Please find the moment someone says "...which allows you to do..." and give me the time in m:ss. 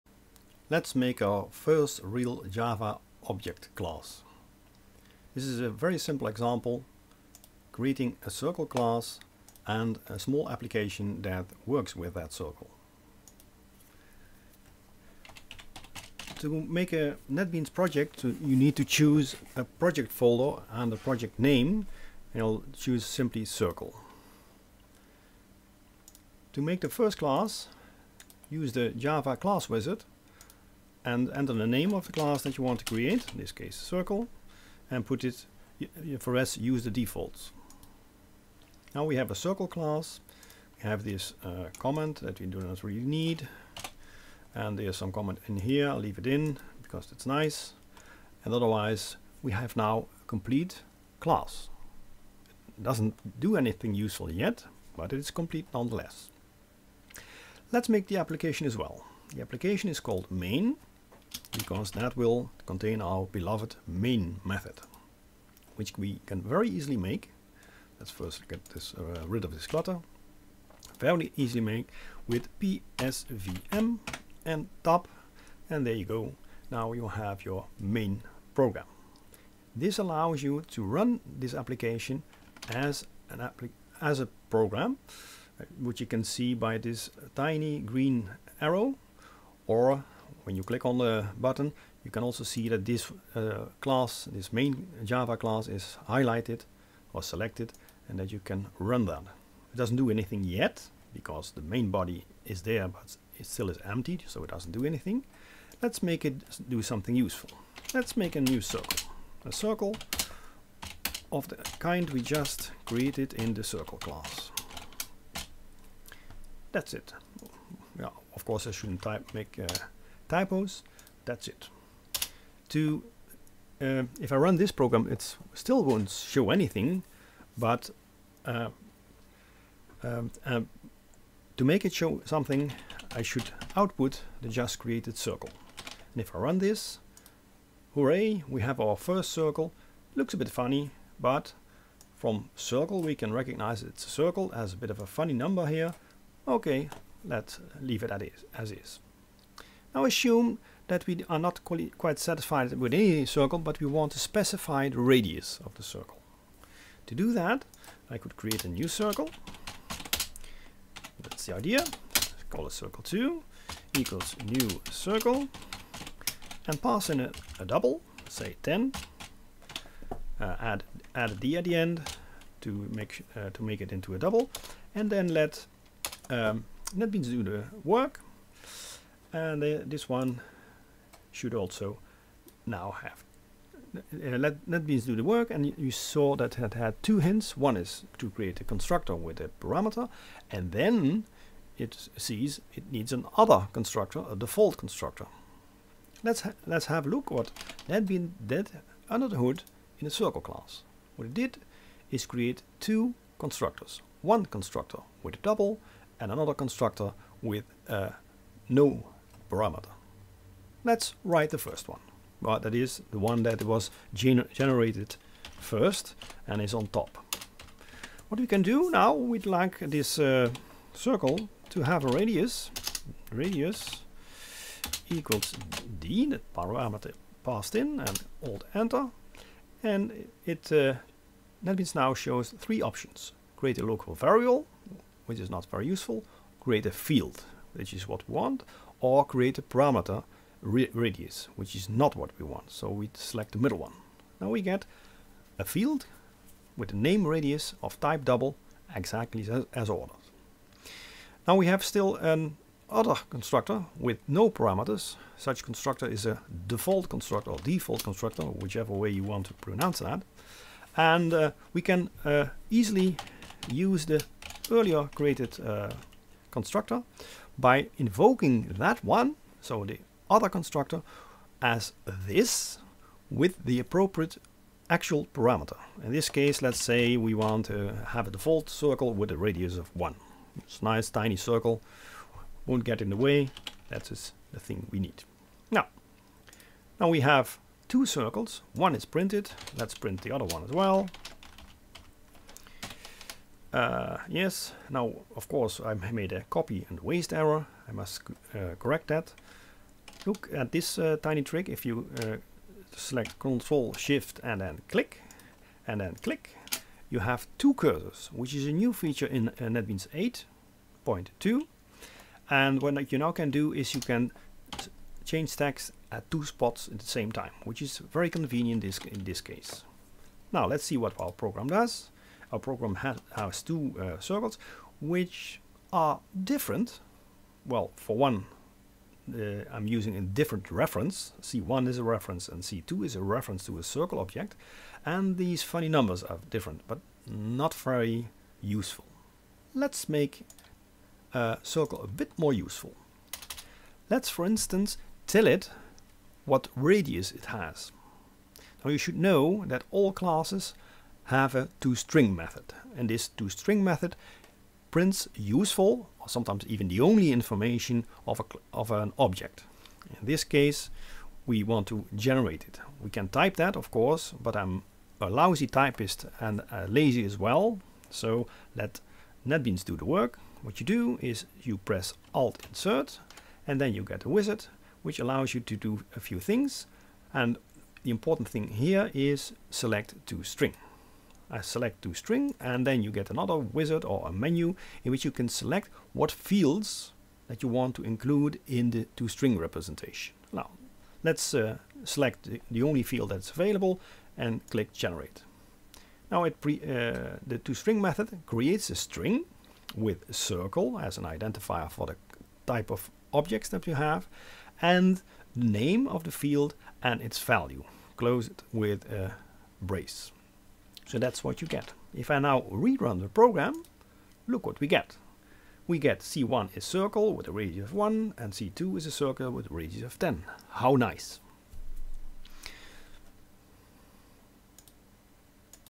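6:15.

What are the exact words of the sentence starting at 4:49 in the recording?
Let's print the other one as well.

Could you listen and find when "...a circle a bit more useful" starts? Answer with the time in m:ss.
5:41.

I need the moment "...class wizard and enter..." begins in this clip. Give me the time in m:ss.
0:29.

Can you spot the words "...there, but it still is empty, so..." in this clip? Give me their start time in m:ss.
1:42.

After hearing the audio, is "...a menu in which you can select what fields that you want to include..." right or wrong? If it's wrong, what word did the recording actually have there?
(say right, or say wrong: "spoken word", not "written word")
right.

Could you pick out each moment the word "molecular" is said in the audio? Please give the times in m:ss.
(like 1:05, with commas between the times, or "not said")
not said.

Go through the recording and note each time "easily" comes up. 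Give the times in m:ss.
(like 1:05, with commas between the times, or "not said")
1:06, 1:11, 4:22.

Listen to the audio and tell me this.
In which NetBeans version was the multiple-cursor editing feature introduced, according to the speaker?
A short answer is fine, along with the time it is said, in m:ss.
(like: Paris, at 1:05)
8.2, at 5:09.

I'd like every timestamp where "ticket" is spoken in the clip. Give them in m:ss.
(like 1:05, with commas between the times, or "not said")
not said.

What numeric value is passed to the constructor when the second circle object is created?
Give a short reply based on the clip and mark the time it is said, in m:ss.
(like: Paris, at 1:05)
10, at 2:48.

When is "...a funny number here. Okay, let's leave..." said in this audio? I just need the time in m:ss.
2:25.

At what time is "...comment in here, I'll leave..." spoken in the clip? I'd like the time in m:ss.
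0:45.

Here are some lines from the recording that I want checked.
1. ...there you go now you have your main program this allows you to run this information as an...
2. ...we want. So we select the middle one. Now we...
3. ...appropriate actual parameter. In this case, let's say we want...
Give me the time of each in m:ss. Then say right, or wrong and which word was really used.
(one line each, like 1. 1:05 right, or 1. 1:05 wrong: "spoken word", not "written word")
1. 1:15 wrong: "application", not "information"
2. 4:02 right
3. 4:33 right.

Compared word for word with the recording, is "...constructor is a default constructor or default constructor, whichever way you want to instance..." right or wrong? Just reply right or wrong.
wrong.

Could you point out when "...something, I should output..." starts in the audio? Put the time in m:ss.
2:12.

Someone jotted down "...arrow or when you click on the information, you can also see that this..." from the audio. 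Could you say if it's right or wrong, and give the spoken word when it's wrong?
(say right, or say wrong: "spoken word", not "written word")
wrong: "button", not "information".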